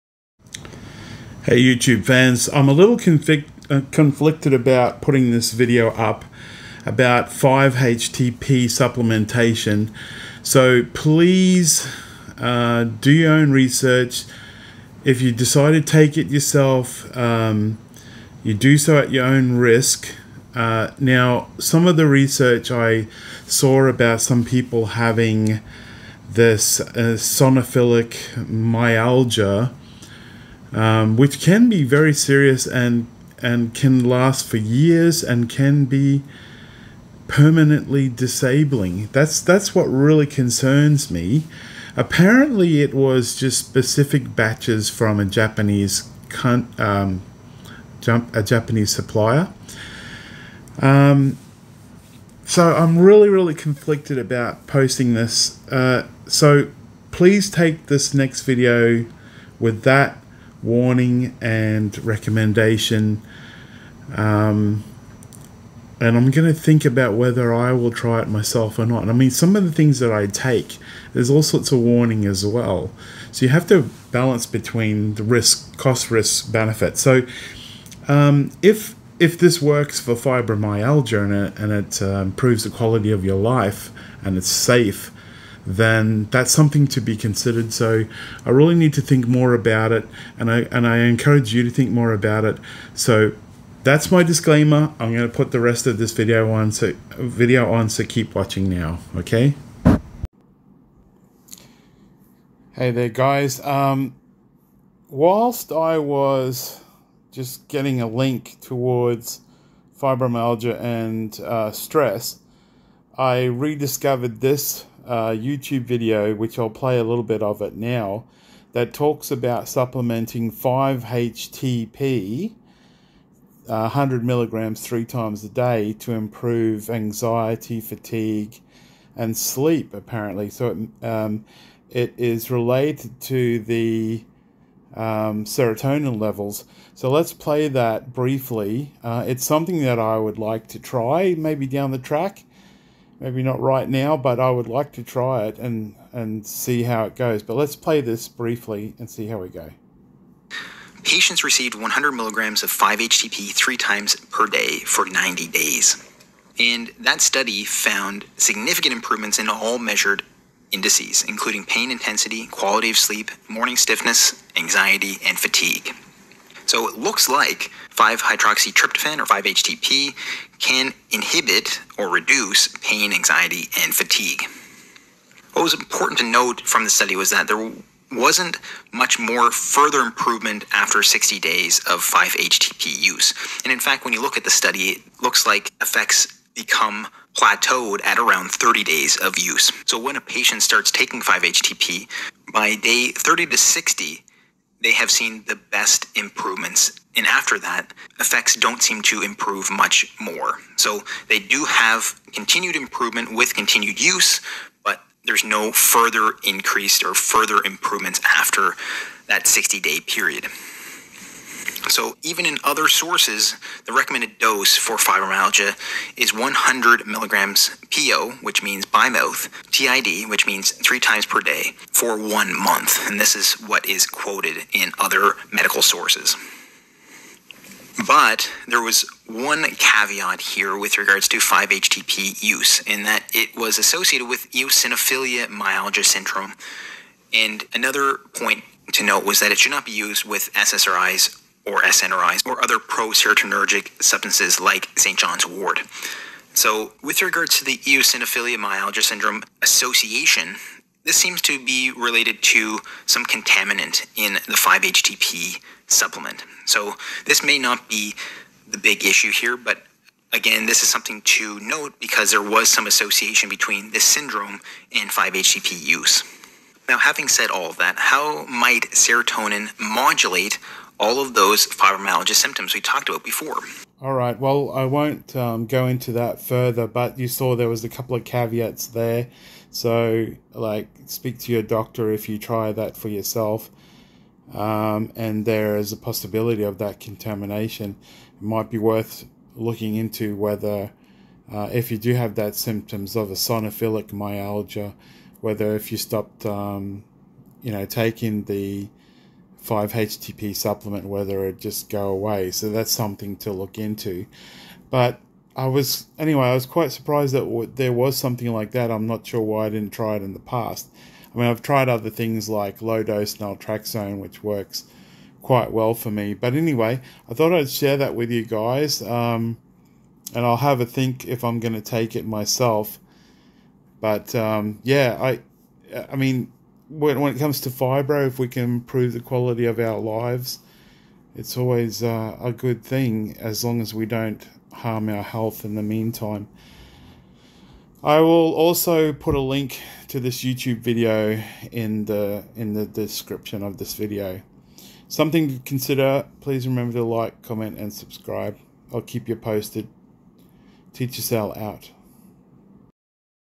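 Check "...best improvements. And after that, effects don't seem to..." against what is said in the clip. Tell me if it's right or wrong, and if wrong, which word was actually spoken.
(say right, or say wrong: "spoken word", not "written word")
right.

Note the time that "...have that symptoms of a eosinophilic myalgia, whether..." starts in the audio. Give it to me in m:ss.
4:52.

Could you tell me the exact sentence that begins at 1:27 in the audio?
So I really need to think more about it, and I and I encourage you to think more about it.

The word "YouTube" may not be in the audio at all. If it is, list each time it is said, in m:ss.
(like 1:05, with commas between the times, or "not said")
0:01, 1:55, 5:40.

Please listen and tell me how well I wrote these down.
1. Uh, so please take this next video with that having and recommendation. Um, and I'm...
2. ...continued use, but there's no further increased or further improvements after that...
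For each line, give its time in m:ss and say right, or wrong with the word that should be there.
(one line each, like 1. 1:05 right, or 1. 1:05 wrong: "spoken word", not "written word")
1. 0:55 wrong: "warning", not "having"
2. 3:23 right.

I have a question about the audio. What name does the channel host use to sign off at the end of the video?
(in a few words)
Teacher Sal.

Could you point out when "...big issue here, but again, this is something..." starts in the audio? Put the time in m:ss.
4:18.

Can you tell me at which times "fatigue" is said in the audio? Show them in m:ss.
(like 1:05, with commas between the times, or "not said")
2:07, 2:45, 2:53.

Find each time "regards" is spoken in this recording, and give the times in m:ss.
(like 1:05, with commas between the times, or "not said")
3:50, 4:07.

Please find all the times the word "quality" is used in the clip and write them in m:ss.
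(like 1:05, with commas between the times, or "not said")
1:22, 2:42, 5:29.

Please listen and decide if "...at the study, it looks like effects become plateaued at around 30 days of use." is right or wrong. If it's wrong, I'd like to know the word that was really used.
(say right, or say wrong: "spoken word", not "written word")
right.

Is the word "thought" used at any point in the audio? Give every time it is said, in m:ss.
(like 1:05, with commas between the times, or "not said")
5:17.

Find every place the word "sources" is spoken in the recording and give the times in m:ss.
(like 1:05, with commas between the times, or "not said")
3:32, 3:45.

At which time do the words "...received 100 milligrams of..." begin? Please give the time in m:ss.
2:31.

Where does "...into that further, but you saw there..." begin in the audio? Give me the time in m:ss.
4:35.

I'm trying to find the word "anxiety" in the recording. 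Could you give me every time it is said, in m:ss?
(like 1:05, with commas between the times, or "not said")
2:06, 2:44, 2:53.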